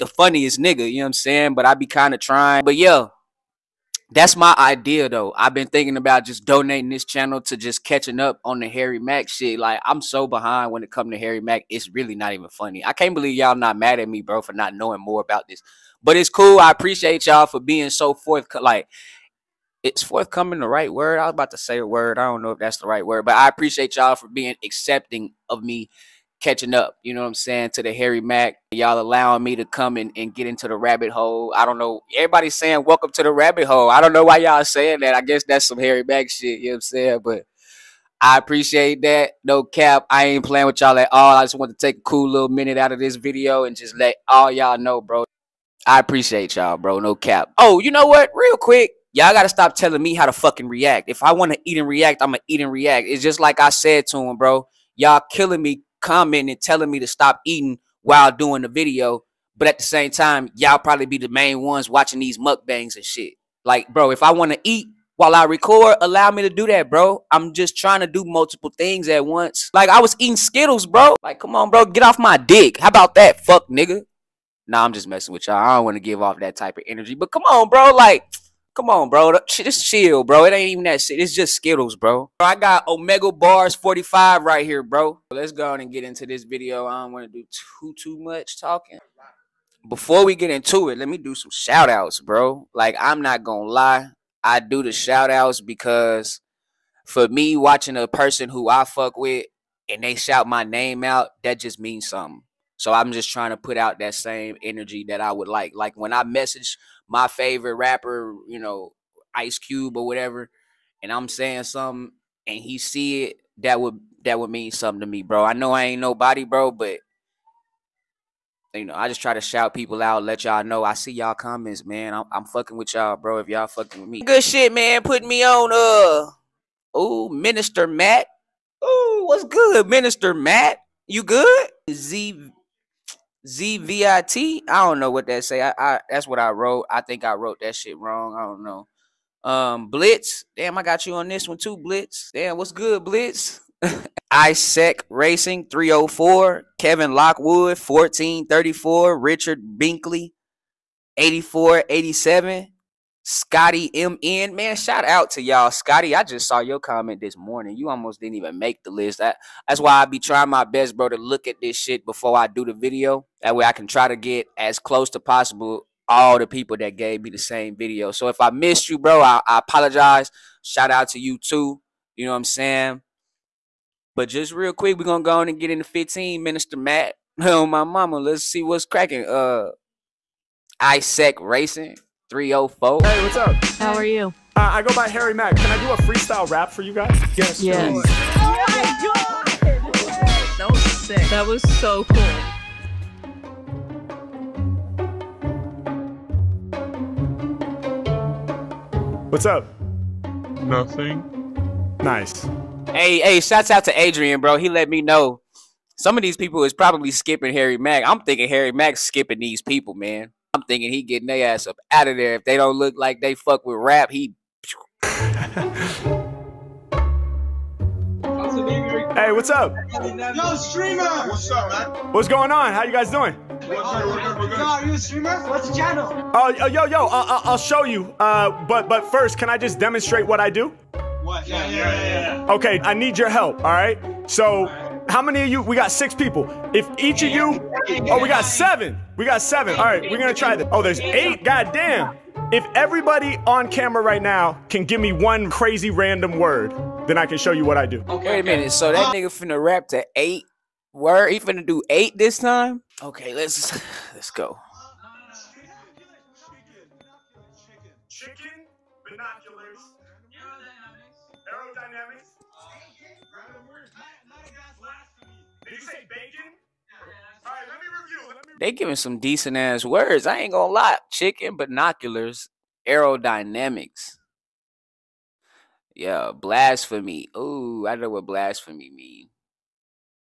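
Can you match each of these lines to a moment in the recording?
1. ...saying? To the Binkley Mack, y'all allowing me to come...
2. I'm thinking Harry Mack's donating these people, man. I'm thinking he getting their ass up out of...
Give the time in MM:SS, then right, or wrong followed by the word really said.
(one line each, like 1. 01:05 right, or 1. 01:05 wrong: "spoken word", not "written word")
1. 00:27 wrong: "Harry", not "Binkley"
2. 03:28 wrong: "skipping", not "donating".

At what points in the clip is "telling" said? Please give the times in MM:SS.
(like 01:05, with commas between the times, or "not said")
00:49, 00:56.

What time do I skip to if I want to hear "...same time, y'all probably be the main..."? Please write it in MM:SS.
00:59.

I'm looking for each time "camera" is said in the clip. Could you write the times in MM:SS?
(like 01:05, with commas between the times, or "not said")
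04:03.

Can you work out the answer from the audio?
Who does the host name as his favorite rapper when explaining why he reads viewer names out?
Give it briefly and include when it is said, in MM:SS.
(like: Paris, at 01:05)
Ice Cube, at 01:49.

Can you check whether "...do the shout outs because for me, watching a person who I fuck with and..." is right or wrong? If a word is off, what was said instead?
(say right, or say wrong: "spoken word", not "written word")
right.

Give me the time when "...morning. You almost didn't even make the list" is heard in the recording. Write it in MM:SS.
02:37.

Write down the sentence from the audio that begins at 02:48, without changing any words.
So if I missed you, bro, I, I apologize.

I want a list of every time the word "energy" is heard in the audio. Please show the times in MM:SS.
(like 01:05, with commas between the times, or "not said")
01:16, 01:44.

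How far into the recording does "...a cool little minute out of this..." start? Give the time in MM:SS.
00:41.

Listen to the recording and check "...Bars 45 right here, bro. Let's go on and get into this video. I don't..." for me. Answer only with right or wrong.
right.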